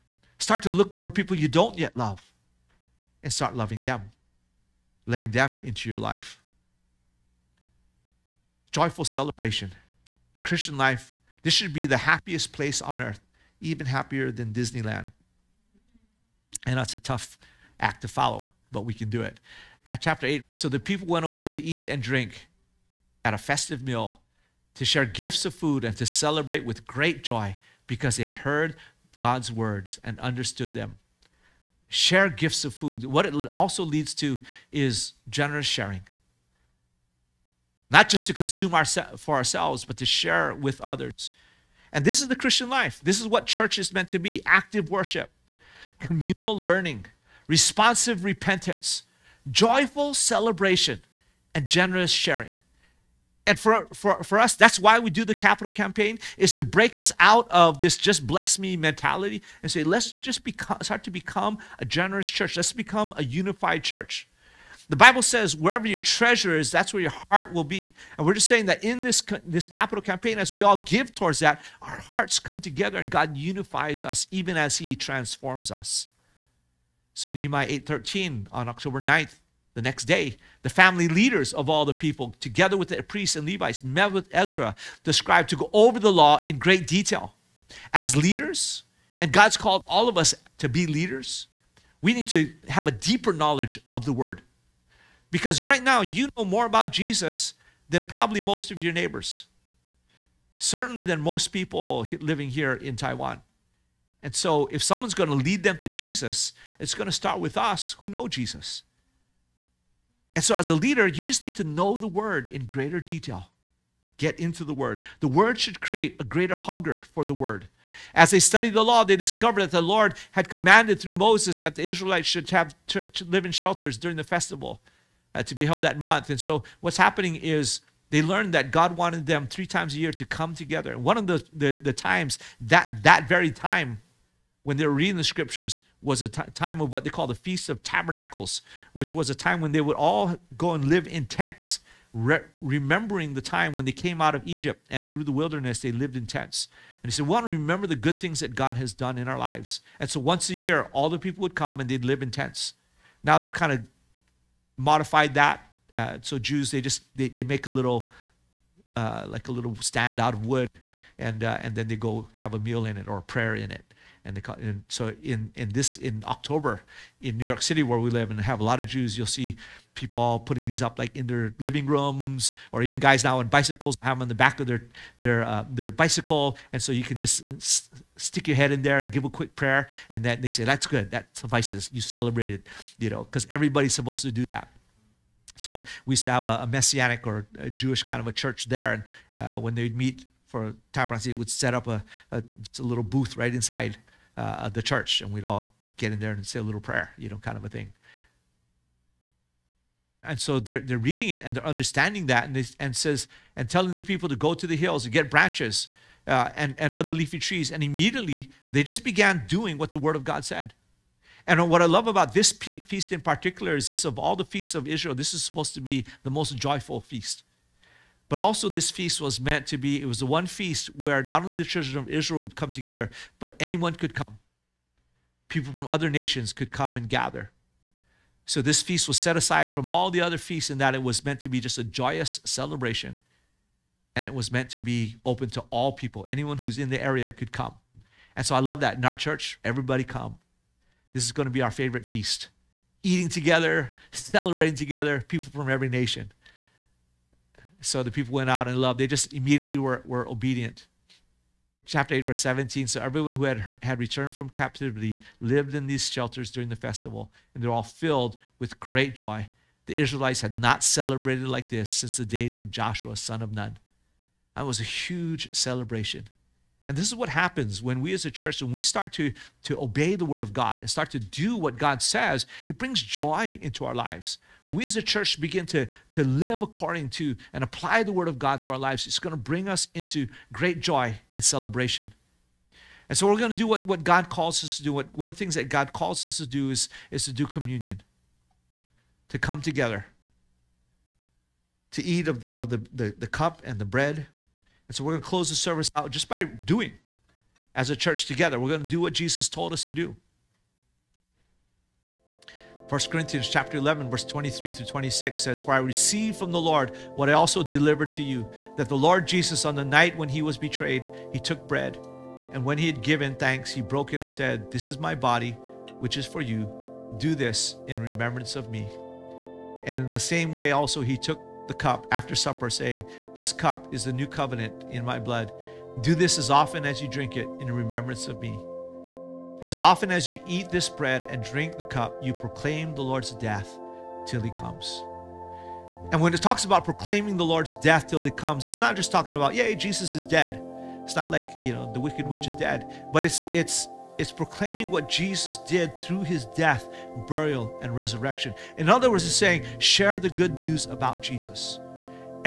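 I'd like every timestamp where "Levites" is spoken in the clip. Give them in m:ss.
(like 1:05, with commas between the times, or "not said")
1:23.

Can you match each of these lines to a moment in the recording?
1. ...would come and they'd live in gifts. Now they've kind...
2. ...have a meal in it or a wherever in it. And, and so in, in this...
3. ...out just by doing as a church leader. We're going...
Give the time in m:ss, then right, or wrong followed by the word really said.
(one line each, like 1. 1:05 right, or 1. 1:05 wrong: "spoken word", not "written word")
1. 2:31 wrong: "tents", not "gifts"
2. 2:42 wrong: "prayer", not "wherever"
3. 4:55 wrong: "together", not "leader".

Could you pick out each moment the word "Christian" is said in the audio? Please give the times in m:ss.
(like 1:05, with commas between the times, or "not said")
0:10, 0:42.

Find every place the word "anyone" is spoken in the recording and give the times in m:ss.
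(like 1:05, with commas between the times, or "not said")
3:43, 3:56.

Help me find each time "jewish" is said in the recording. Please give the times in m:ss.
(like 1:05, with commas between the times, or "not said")
3:07.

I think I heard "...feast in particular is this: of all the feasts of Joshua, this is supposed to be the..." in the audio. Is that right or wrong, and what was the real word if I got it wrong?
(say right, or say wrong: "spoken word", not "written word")
wrong: "Israel", not "Joshua".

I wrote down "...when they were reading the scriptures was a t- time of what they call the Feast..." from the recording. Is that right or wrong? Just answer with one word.
right.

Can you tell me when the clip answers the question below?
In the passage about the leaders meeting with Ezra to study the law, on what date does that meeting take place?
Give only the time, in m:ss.
1:18.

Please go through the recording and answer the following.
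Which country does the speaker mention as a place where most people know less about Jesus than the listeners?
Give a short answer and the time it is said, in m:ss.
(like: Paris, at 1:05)
Taiwan, at 1:42.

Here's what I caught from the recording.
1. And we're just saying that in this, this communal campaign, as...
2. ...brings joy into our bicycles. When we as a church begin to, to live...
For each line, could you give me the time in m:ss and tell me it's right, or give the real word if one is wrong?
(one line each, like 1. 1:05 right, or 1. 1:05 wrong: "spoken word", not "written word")
1. 1:08 wrong: "capital", not "communal"
2. 4:32 wrong: "lives", not "bicycles".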